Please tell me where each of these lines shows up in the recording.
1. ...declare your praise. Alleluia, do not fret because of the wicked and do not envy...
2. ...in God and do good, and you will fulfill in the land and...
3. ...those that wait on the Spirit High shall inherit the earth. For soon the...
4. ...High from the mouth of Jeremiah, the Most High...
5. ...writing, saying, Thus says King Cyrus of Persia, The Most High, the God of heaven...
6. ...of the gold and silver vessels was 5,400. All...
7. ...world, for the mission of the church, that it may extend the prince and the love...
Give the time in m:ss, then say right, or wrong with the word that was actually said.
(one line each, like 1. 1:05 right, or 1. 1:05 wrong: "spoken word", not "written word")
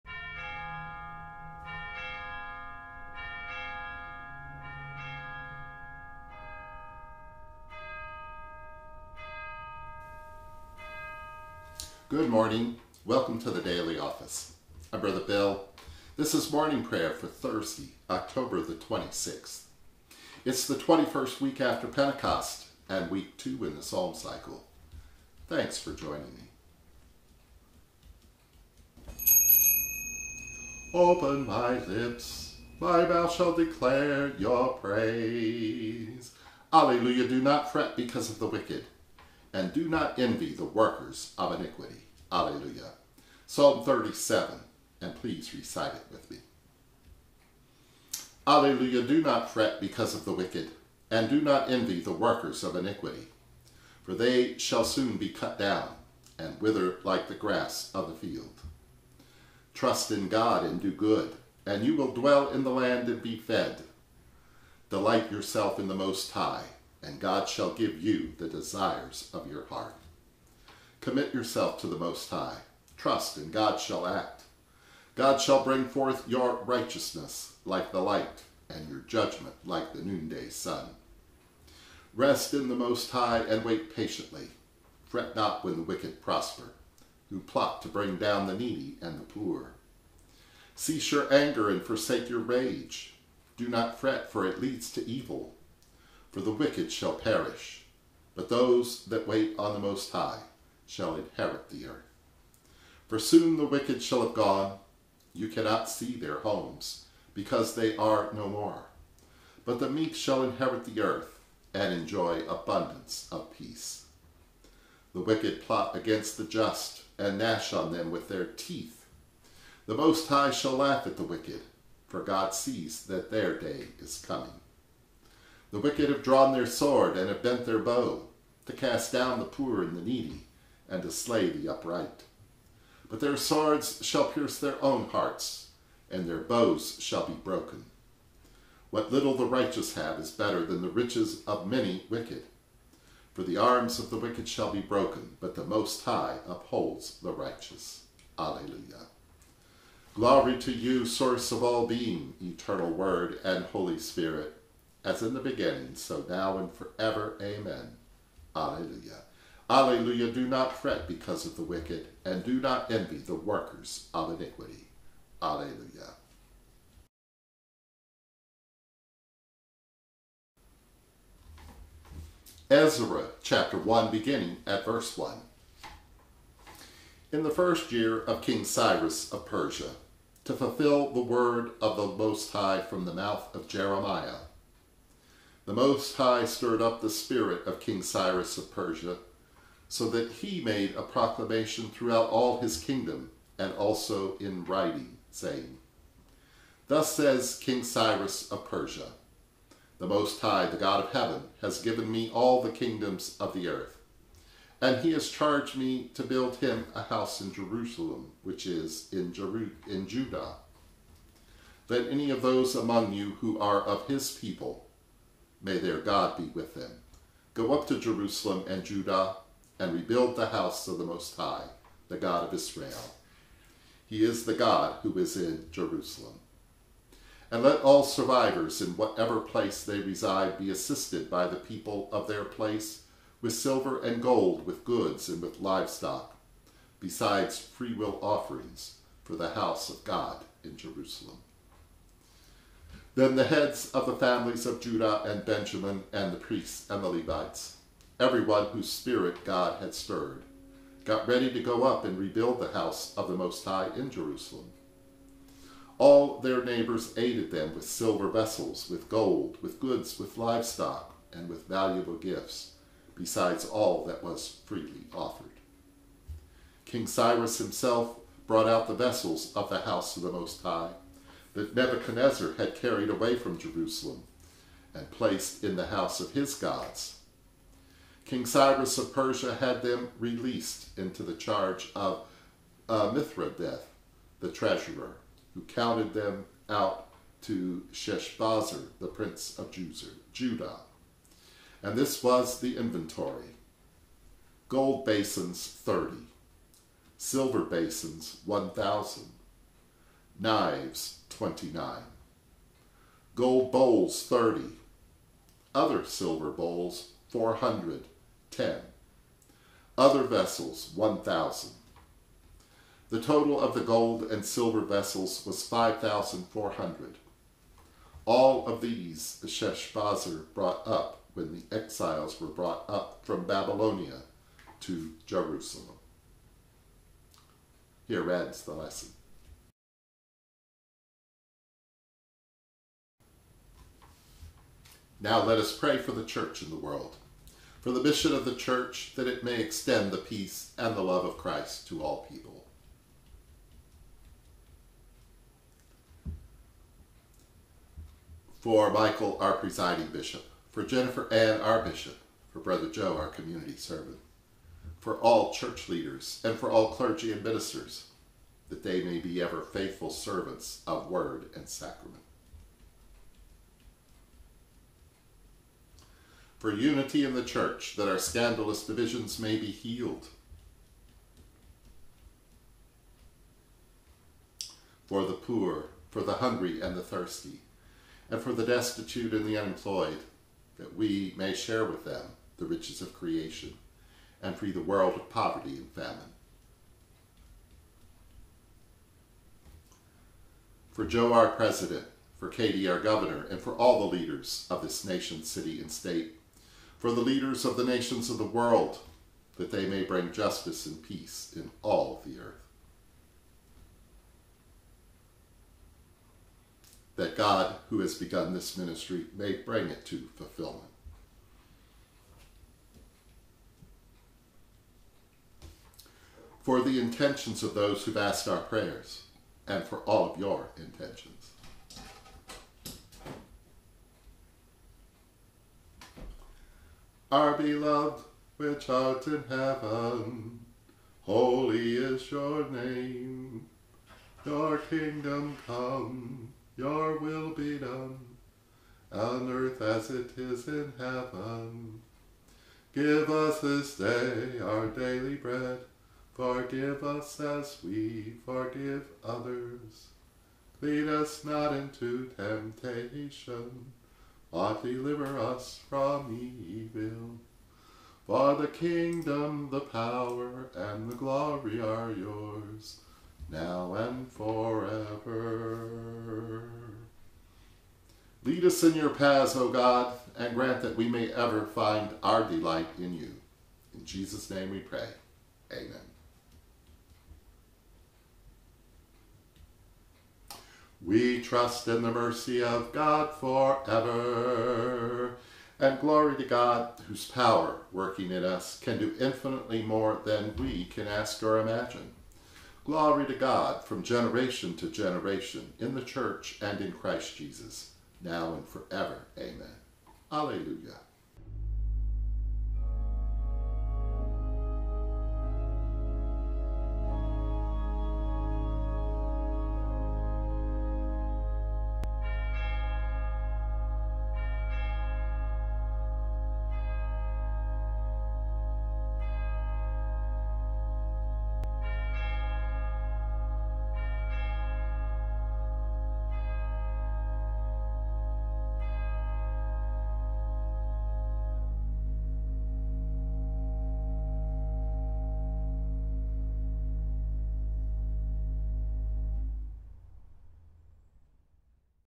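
1. 0:33 right
2. 1:00 wrong: "dwell", not "fulfill"
3. 1:38 wrong: "Most", not "Spirit"
4. 3:02 right
5. 3:14 right
6. 5:13 right
7. 5:36 wrong: "peace", not "prince".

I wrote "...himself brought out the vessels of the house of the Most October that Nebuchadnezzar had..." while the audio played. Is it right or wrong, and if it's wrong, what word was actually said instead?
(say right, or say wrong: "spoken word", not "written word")
wrong: "High", not "October".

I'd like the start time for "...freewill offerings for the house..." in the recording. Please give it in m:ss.
3:57.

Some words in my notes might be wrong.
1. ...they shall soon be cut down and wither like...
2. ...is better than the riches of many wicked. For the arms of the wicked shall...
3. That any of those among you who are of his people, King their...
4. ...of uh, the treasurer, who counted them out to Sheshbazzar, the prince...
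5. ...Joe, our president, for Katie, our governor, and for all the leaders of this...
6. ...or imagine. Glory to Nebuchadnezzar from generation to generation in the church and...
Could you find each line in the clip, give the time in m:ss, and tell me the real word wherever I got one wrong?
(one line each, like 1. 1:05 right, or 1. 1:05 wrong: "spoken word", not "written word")
1. 0:54 right
2. 2:20 right
3. 3:31 wrong: "May", not "King"
4. 4:41 right
5. 6:31 right
6. 8:11 wrong: "God", not "Nebuchadnezzar".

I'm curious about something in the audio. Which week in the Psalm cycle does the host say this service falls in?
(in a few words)
Week two.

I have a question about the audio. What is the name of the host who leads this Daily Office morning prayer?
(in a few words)
Brother Bill.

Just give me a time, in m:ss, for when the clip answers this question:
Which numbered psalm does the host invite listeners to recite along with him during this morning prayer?
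0:43.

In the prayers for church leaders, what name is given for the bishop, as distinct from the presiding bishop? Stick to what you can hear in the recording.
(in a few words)
Jennifer Ann.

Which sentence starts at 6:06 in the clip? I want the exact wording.
for unity in the church, that our scandalous divisions may be healed.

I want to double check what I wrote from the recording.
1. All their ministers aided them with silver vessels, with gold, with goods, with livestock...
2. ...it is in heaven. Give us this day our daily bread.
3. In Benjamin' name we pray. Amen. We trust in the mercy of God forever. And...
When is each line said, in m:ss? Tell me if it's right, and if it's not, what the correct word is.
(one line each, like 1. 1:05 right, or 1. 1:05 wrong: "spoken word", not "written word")
1. 4:15 wrong: "neighbors", not "ministers"
2. 7:20 right
3. 7:53 wrong: "Jesus", not "Benjamin".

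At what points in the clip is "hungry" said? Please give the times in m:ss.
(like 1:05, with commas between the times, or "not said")
6:16.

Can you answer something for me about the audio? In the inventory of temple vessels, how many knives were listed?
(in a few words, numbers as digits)
29.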